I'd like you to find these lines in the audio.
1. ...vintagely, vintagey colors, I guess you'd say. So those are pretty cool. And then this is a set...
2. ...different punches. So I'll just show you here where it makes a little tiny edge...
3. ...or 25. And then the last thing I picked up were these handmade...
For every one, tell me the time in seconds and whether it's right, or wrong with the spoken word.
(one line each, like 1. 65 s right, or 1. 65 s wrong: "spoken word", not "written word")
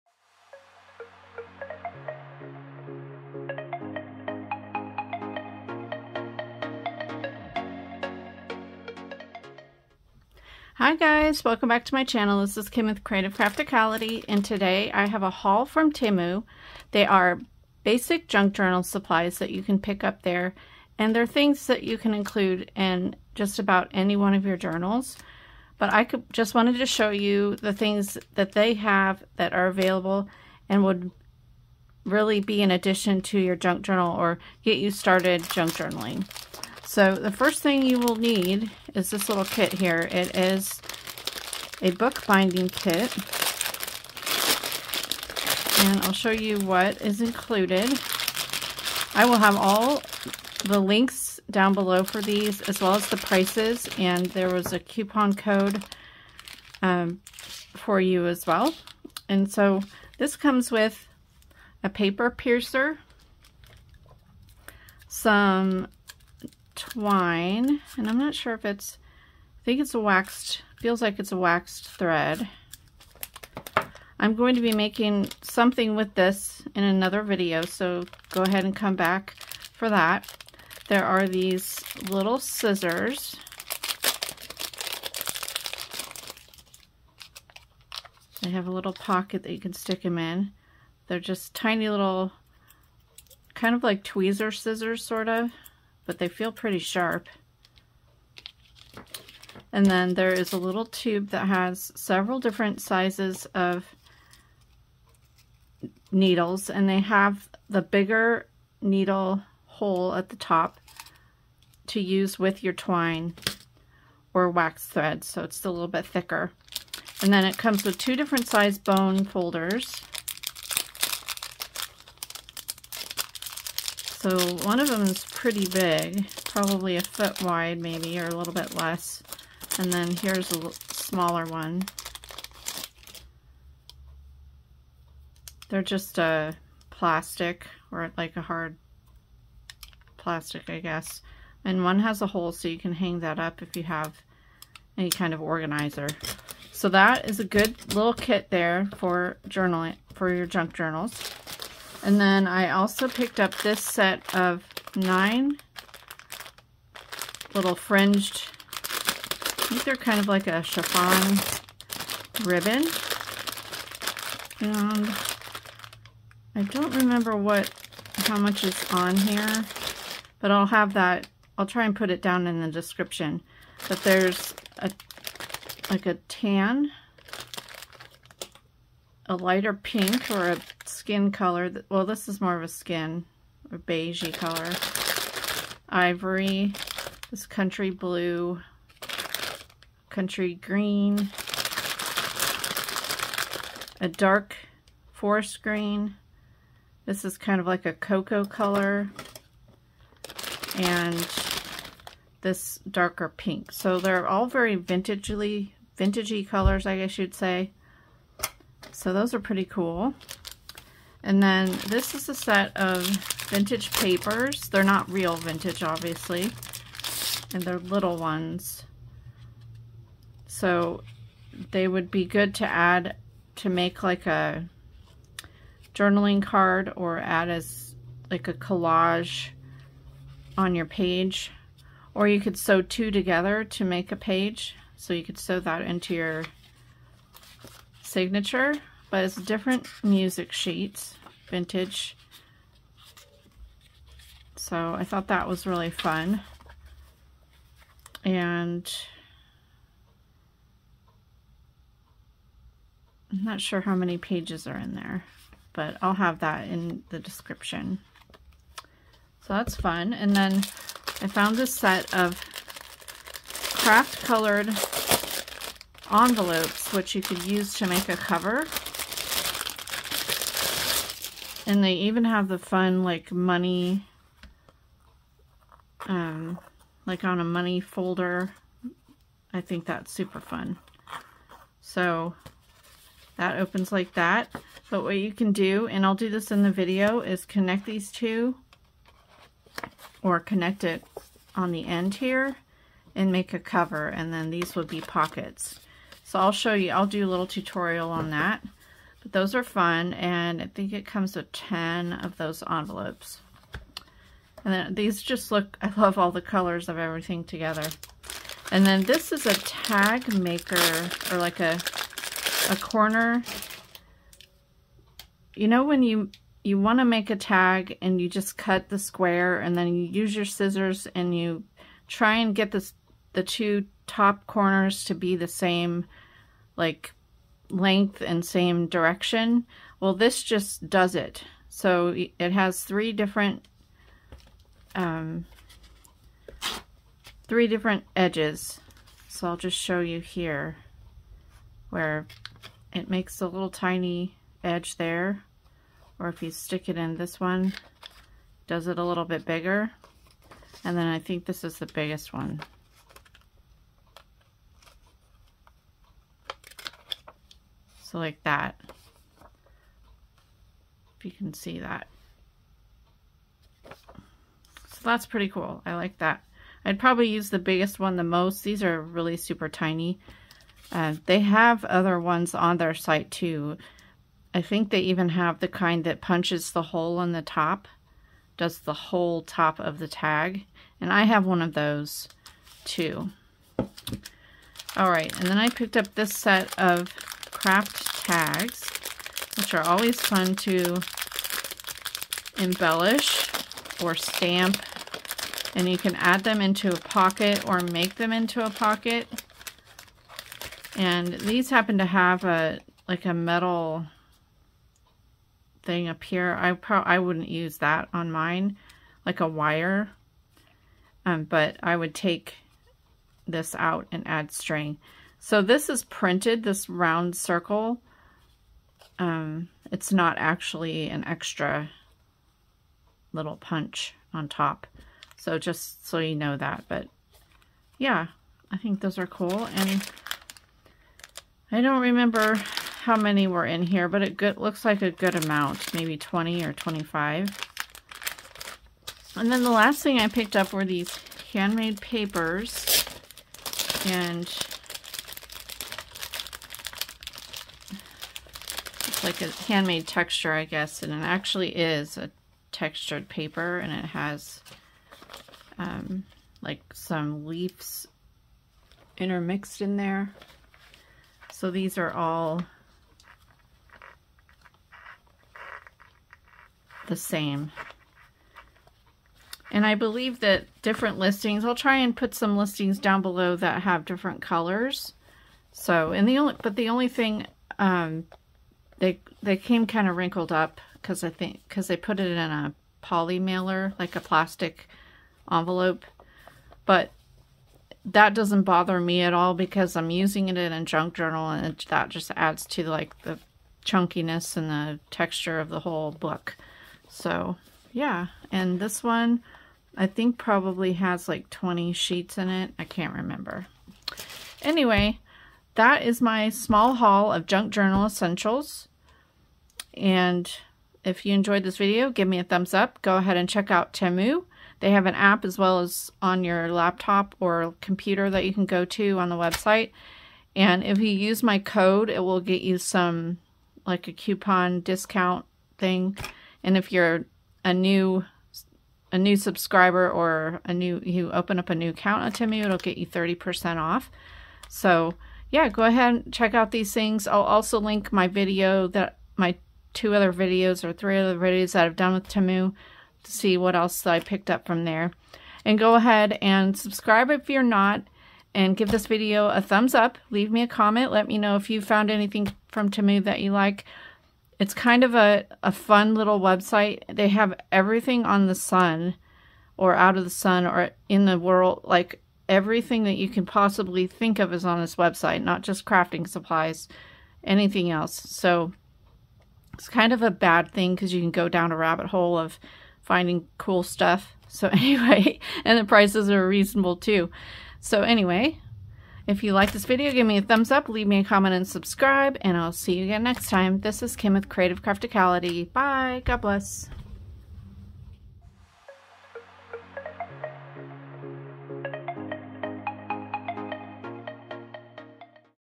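1. 204 s right
2. 337 s wrong: "edges", not "punches"
3. 436 s right.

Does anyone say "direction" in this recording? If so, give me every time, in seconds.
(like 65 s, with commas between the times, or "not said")
328 s.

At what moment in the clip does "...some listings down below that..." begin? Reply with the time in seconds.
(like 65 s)
472 s.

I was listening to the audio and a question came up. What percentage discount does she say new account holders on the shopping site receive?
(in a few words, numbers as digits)
30%.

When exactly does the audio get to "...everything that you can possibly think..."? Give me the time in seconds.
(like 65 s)
562 s.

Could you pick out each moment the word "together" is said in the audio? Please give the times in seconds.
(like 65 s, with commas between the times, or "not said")
233 s, 307 s.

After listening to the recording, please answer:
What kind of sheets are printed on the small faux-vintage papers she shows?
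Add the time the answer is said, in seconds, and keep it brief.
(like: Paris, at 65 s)
music sheets, at 240 s.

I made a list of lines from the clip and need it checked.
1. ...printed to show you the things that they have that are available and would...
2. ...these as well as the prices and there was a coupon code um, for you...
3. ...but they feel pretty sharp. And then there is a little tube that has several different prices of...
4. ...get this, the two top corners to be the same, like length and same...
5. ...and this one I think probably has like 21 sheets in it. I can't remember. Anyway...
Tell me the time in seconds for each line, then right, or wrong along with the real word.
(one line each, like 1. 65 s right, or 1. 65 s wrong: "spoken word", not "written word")
1. 26 s wrong: "wanted", not "printed"
2. 52 s right
3. 96 s wrong: "sizes", not "prices"
4. 322 s right
5. 498 s wrong: "20", not "21".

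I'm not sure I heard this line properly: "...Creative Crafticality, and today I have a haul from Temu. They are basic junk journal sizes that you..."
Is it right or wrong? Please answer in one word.
wrong.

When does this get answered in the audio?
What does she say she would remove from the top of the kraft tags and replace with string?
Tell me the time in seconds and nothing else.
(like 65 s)
409 s.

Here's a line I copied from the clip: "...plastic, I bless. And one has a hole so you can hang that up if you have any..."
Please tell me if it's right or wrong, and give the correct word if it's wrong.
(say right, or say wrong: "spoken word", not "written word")
wrong: "guess", not "bless".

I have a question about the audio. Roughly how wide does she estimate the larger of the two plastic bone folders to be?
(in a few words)
a foot.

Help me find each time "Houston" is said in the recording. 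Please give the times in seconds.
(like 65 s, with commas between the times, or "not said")
not said.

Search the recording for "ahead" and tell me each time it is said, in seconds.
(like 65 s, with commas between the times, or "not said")
78 s, 513 s, 535 s, 545 s.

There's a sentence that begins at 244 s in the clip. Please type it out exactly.
So I thought that was really fun.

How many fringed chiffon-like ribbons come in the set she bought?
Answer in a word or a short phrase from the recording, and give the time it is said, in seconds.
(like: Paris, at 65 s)
9, at 154 s.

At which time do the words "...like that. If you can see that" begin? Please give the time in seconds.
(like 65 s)
358 s.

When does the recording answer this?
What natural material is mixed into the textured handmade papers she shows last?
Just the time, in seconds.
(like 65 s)
457 s.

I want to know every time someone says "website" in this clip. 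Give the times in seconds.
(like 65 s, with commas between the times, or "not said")
519 s, 556 s, 564 s.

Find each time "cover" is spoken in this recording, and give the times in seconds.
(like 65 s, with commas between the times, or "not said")
268 s, 293 s.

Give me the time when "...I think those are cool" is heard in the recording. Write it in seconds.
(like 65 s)
428 s.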